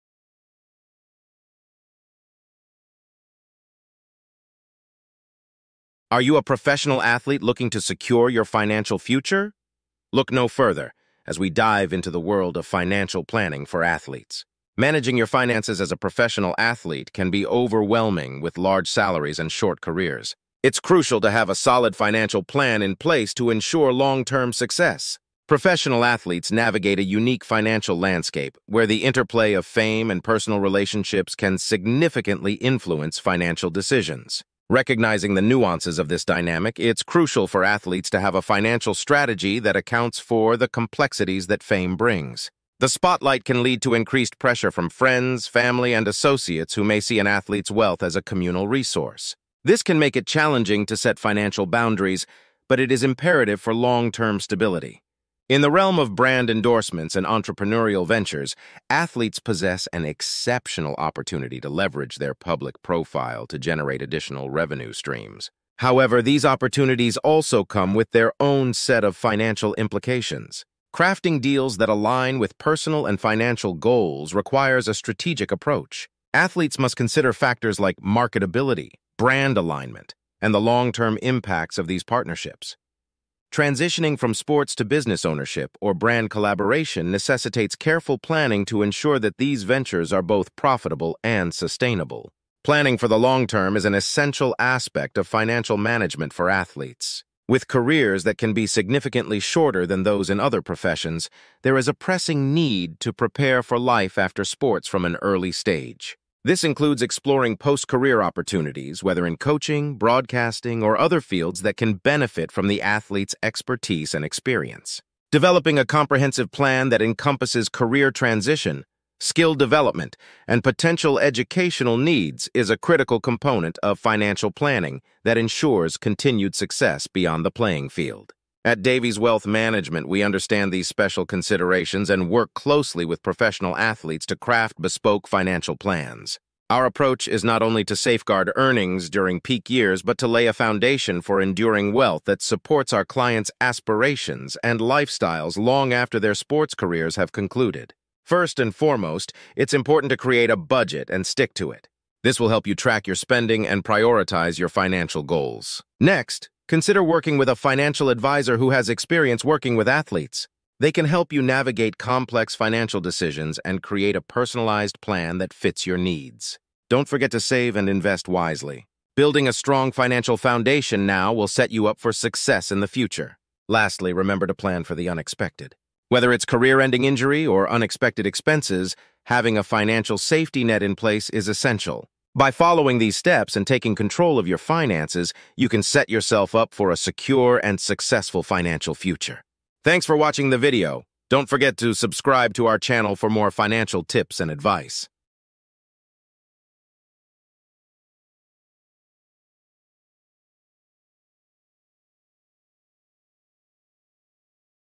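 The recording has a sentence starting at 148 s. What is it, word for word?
First and foremost, it's important to create a budget and stick to it.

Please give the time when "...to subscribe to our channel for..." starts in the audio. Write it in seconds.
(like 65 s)
191 s.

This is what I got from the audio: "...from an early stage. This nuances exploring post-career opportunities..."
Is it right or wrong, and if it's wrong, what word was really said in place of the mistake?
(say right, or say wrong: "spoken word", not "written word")
wrong: "includes", not "nuances".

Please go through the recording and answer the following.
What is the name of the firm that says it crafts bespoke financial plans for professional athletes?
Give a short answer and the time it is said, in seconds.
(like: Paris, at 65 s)
Davies Wealth Management, at 128 s.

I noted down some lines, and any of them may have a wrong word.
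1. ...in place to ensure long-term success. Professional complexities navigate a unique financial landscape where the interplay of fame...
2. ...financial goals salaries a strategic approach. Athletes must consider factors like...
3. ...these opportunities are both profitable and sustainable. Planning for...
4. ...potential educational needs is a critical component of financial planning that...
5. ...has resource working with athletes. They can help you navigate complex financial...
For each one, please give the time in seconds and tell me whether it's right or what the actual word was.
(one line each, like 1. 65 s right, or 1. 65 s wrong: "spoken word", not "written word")
1. 22 s wrong: "athletes", not "complexities"
2. 73 s wrong: "requires", not "salaries"
3. 89 s wrong: "ventures", not "opportunities"
4. 120 s right
5. 158 s wrong: "experience", not "resource".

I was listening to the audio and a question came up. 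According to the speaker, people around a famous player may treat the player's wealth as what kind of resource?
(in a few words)
communal resource.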